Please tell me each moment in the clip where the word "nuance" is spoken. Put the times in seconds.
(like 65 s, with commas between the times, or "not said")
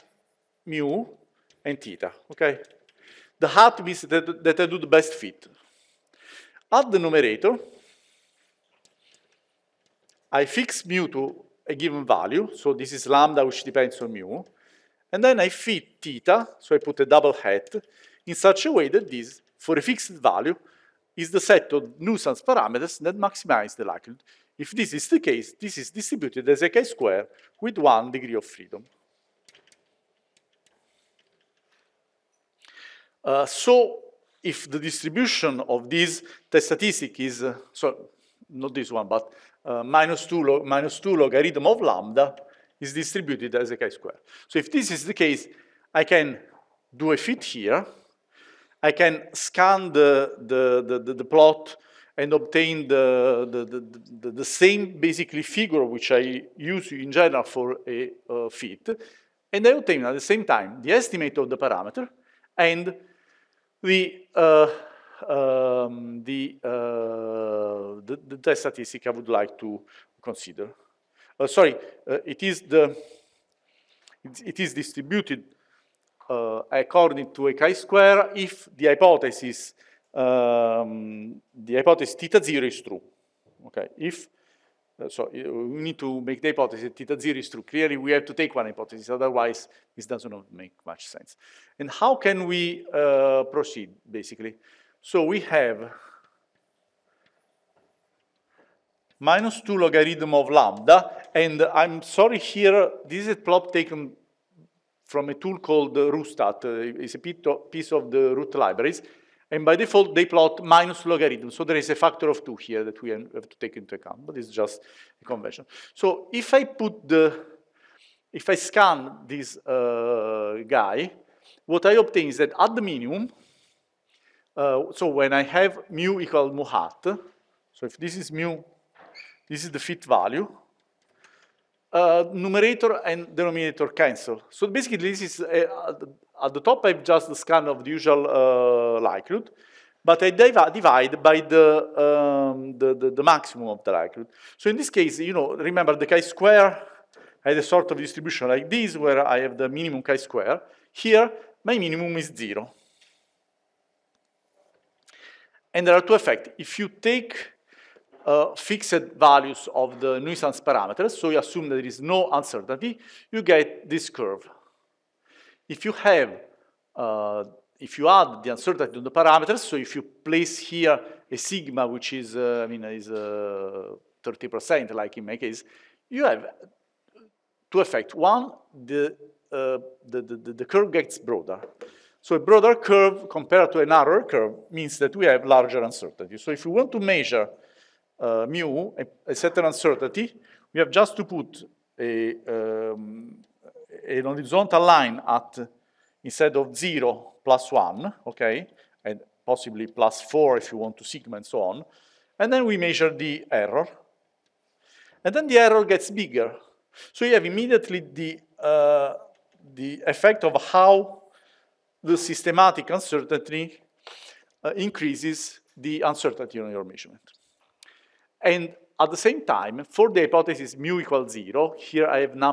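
not said.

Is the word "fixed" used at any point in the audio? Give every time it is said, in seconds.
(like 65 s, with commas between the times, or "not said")
19 s, 158 s.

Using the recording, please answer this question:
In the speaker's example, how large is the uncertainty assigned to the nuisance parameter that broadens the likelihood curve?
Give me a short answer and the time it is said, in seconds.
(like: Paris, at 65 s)
30%, at 173 s.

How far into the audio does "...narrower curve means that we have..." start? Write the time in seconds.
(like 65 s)
183 s.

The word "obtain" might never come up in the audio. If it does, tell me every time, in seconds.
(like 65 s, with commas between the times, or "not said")
52 s, 59 s, 121 s.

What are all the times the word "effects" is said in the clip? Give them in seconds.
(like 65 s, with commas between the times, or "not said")
156 s, 177 s, 210 s.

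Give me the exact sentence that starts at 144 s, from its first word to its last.
So in this case, you know, remember the chi-square had a sort of distribution like this, where I have the minimum chi-square.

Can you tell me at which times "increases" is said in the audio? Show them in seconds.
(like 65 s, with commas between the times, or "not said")
214 s.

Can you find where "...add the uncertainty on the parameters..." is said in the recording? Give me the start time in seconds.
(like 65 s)
168 s.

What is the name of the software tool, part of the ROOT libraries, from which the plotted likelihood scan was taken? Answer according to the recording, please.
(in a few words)
RooStats.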